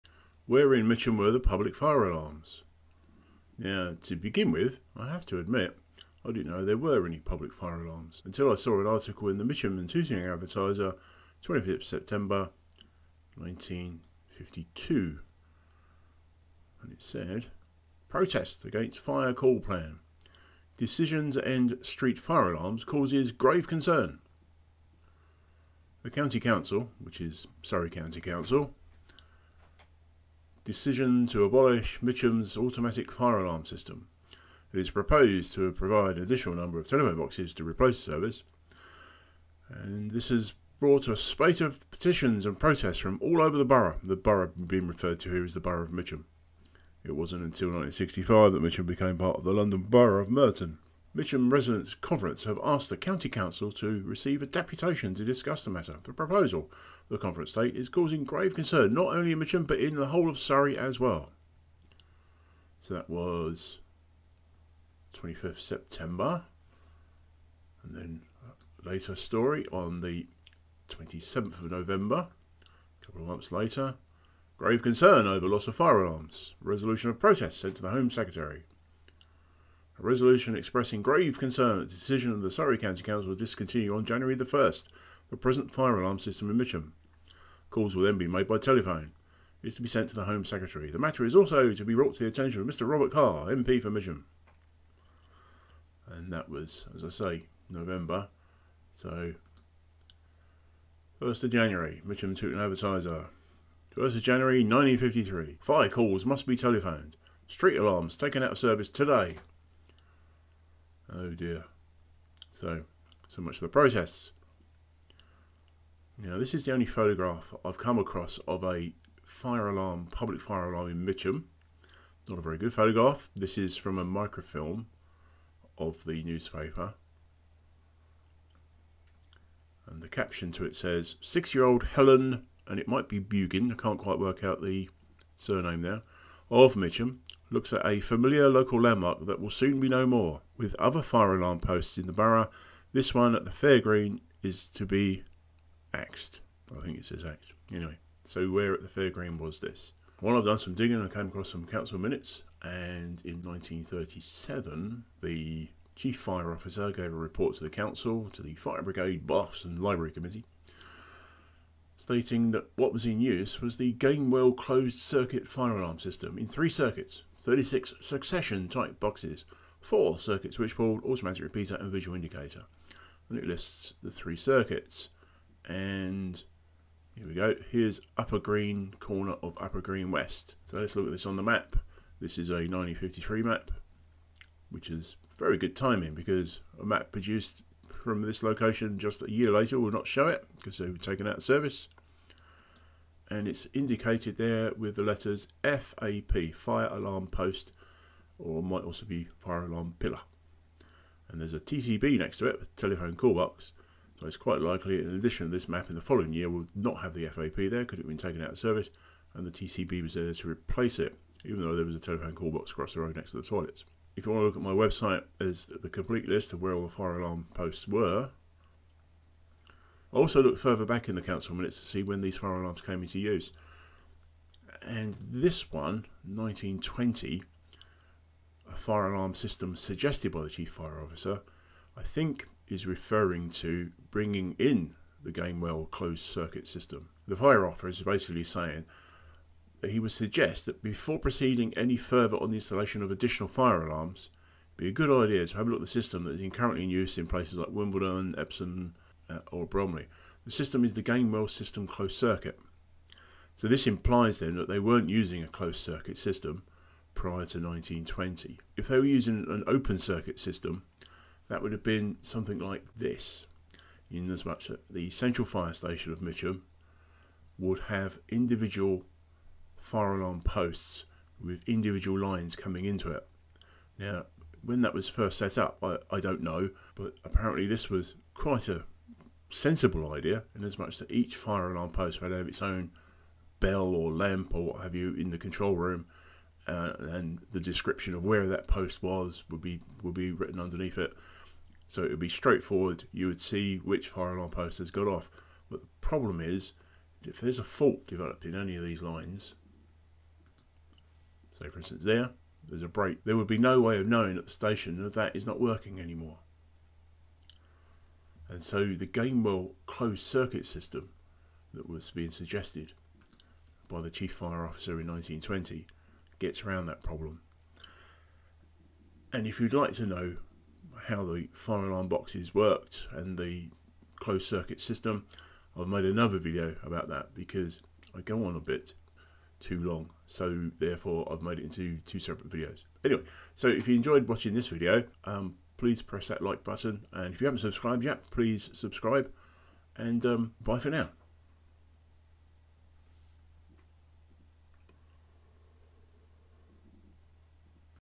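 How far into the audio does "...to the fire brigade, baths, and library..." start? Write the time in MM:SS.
02:38.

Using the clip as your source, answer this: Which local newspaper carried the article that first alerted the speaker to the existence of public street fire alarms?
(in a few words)
Mitcham and Tooting Advertiser.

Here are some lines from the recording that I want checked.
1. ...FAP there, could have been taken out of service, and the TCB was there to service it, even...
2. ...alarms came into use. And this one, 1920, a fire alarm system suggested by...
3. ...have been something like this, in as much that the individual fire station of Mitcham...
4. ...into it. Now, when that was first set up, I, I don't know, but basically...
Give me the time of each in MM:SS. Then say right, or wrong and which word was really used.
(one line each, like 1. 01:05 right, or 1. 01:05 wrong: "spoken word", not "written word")
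1. 03:27 wrong: "replace", not "service"
2. 03:42 right
3. 04:21 wrong: "central", not "individual"
4. 04:32 wrong: "apparently", not "basically".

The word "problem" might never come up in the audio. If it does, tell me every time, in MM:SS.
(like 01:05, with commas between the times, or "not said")
04:55, 05:17.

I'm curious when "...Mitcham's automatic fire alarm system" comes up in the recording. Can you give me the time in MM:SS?
00:32.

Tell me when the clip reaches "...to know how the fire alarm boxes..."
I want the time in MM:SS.
05:19.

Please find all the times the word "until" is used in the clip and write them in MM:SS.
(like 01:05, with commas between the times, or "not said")
00:08, 00:47.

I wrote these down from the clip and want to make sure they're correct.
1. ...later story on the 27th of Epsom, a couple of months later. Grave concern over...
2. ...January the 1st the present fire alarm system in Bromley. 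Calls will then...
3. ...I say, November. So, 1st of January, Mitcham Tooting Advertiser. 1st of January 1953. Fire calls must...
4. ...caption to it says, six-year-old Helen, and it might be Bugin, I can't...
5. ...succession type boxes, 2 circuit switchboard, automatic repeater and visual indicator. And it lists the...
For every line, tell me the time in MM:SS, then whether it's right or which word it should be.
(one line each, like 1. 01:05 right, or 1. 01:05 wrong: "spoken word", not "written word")
1. 01:08 wrong: "November", not "Epsom"
2. 01:24 wrong: "Mitcham", not "Bromley"
3. 01:37 right
4. 02:10 right
5. 02:47 wrong: "4", not "2".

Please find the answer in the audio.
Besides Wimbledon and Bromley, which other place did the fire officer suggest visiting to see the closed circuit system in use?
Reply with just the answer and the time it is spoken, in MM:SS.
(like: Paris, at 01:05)
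Epsom, at 04:08.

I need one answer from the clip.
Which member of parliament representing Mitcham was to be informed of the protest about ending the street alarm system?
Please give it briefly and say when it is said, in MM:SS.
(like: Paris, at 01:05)
Robert Carr, at 01:32.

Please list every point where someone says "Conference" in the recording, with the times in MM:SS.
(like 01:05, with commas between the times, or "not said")
00:51, 00:57.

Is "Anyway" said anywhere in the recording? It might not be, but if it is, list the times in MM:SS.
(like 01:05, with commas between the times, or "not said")
02:27, 05:33.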